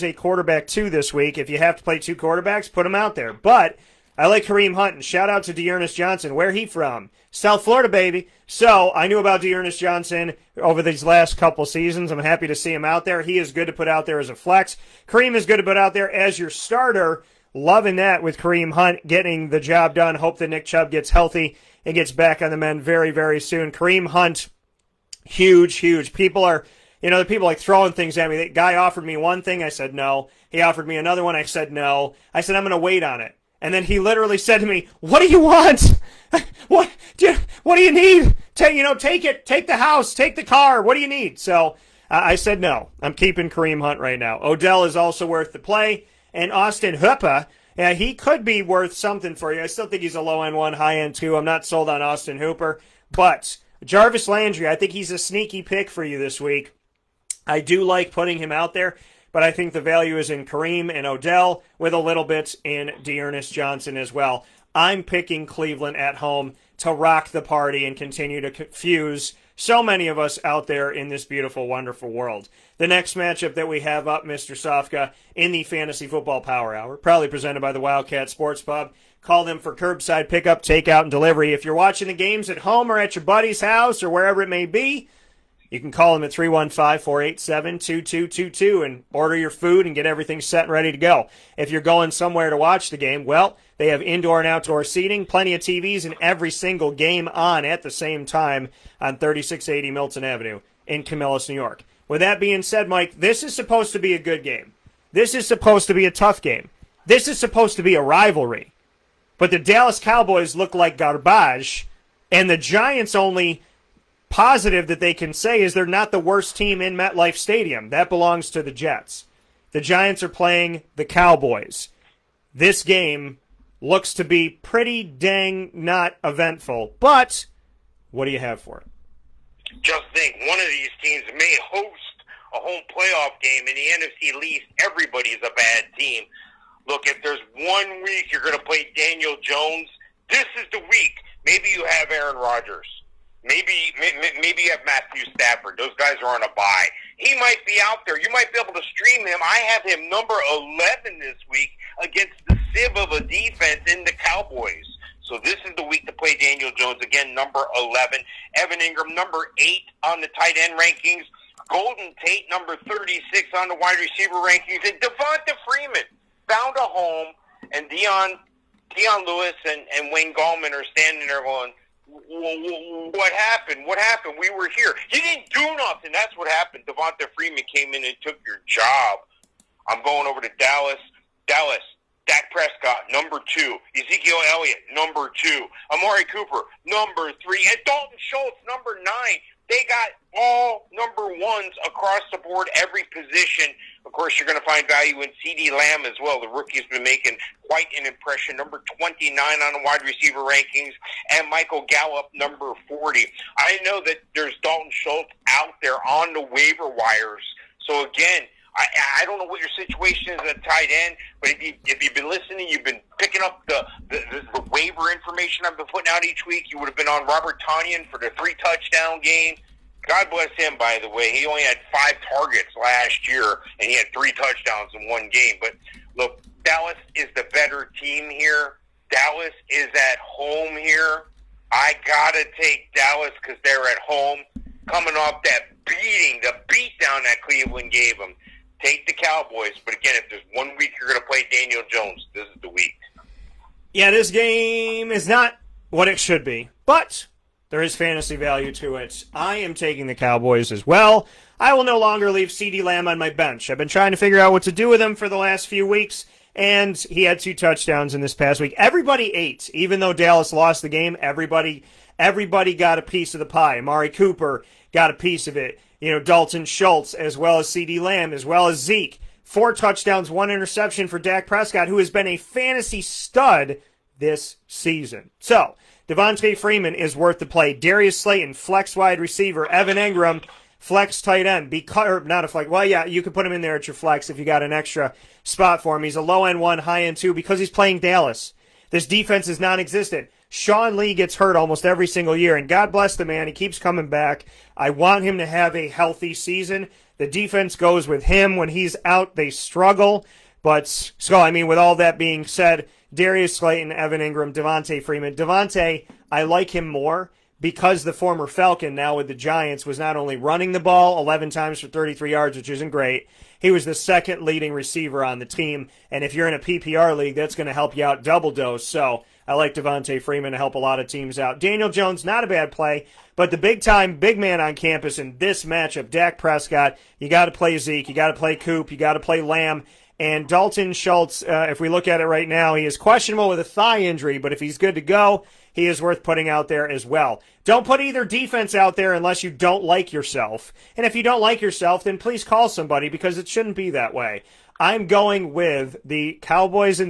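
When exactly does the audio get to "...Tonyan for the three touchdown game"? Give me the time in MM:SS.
03:37.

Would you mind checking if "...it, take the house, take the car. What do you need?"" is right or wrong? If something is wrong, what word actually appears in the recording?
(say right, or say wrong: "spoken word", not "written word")
right.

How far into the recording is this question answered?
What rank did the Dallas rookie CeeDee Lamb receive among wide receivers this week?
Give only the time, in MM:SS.
03:18.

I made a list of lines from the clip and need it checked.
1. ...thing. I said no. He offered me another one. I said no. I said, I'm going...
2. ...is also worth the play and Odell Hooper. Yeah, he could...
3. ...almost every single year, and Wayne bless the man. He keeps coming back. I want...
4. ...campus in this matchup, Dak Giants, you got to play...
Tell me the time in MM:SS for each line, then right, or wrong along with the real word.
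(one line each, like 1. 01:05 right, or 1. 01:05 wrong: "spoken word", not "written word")
1. 00:29 right
2. 00:44 wrong: "Austin", not "Odell"
3. 04:51 wrong: "God", not "Wayne"
4. 05:24 wrong: "Prescott", not "Giants".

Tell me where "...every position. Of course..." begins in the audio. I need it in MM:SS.
03:12.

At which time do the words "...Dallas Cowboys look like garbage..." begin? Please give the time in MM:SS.
01:49.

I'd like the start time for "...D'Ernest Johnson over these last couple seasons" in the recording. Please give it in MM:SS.
00:09.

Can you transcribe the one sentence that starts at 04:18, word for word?
Everybody ate, even though Dallas lost the game.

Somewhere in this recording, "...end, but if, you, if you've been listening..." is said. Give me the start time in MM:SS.
03:30.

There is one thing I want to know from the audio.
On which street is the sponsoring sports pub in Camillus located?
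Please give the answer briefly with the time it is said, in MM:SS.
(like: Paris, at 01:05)
Milton Avenue, at 01:39.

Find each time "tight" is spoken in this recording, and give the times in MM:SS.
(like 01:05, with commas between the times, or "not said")
02:40, 03:30, 04:41.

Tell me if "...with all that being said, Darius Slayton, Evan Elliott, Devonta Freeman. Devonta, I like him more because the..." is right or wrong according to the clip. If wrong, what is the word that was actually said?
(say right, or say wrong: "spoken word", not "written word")
wrong: "Engram", not "Elliott".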